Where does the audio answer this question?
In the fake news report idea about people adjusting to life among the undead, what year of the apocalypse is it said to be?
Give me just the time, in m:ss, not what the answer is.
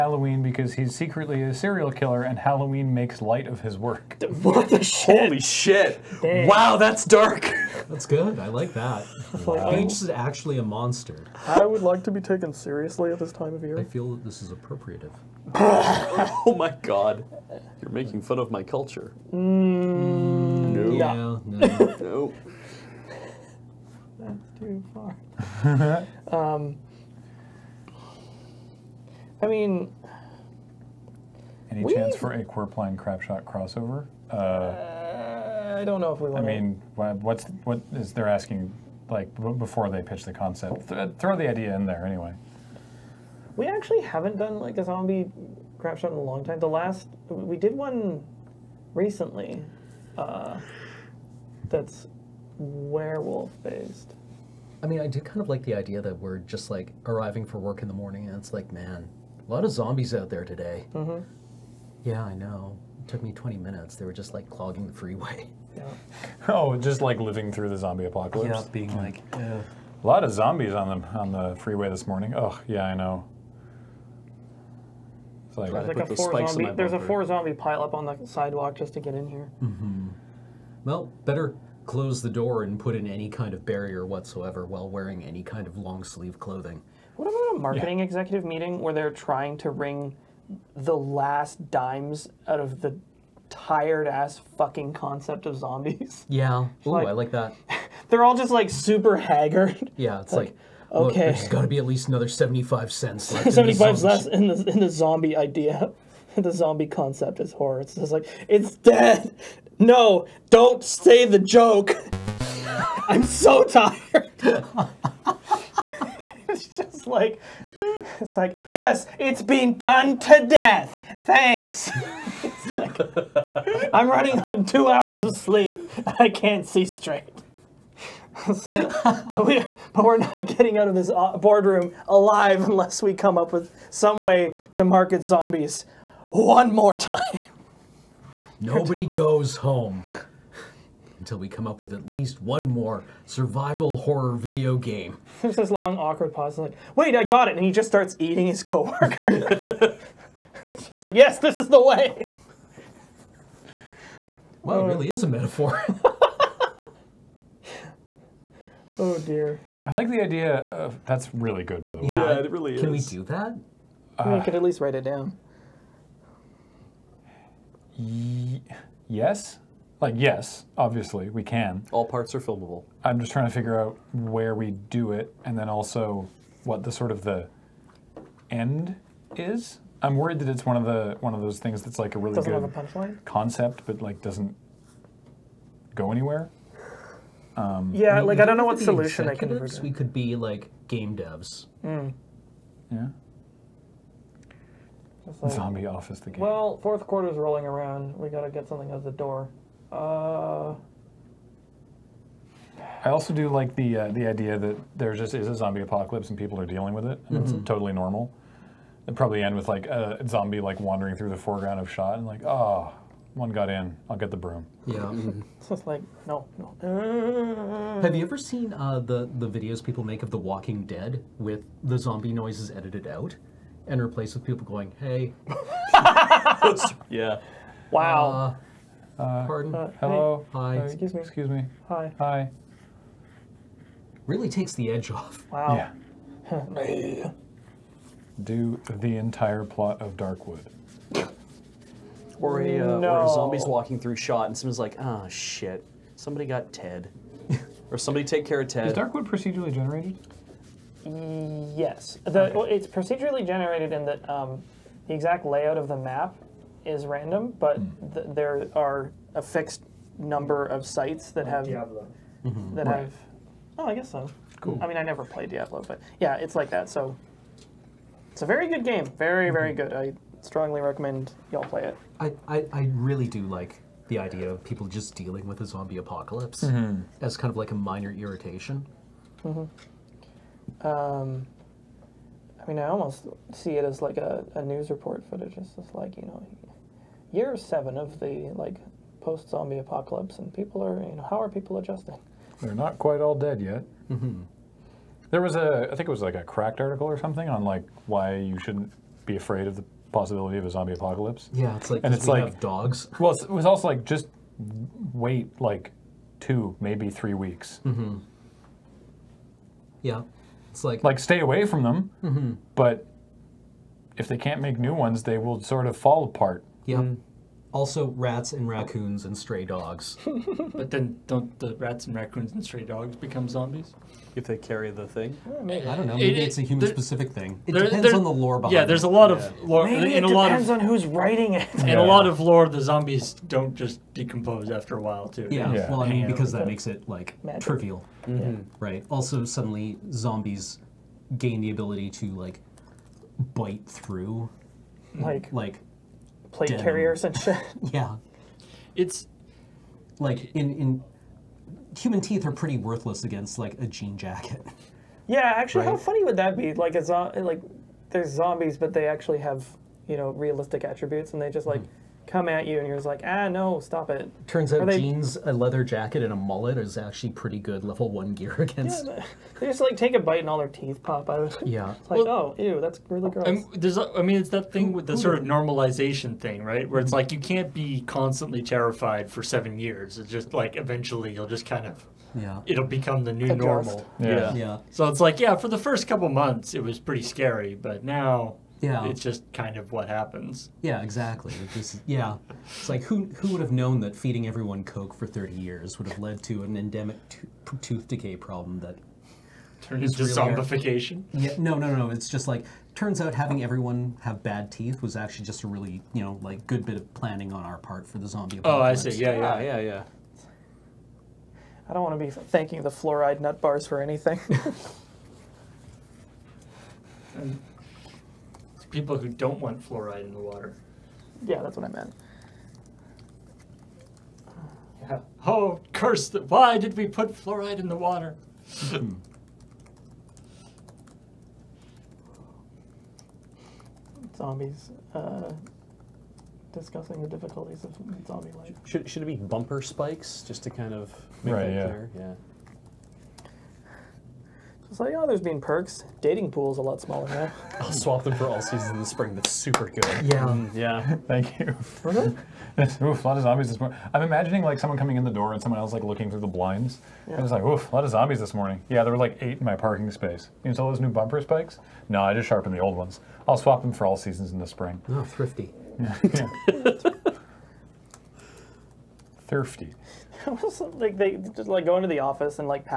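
4:47.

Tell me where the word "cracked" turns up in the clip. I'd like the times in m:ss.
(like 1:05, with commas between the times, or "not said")
4:56.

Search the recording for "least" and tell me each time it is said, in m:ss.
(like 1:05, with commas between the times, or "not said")
1:41, 2:22, 2:44.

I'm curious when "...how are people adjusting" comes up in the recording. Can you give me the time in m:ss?
4:51.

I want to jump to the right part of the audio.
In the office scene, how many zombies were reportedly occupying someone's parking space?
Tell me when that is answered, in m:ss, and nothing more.
7:39.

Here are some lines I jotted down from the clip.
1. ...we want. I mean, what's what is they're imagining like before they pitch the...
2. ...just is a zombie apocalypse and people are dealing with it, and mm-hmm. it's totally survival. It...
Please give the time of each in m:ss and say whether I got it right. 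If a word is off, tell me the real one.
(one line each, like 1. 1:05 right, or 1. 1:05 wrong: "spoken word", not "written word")
1. 0:36 wrong: "asking", not "imagining"
2. 3:25 wrong: "normal", not "survival".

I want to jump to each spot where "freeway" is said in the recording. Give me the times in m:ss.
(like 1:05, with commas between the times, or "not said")
1:04, 1:11.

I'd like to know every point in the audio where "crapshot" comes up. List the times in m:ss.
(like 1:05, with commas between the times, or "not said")
0:32, 0:45.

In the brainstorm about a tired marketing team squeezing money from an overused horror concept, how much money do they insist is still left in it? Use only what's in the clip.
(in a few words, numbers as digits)
75 cents.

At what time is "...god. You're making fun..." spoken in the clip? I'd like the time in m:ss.
0:16.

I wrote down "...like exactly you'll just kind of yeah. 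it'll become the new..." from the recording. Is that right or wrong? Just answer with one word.
wrong.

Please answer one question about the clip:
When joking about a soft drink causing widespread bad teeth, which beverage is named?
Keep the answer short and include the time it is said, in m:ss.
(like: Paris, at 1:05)
Coke, at 6:34.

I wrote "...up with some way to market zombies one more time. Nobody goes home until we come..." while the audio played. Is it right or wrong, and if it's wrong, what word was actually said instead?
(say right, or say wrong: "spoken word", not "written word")
right.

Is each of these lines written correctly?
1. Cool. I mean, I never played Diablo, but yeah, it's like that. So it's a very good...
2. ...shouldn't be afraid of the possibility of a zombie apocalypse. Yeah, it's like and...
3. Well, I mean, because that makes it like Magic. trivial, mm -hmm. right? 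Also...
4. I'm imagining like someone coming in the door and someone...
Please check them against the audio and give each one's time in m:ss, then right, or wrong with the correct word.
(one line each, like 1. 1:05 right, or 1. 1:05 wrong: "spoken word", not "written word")
1. 4:24 right
2. 4:58 right
3. 5:35 right
4. 7:34 right.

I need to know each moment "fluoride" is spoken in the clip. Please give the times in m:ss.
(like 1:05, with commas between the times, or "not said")
6:52, 6:59, 7:07.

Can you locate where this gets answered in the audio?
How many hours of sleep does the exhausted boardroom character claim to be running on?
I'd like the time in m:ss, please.
2:04.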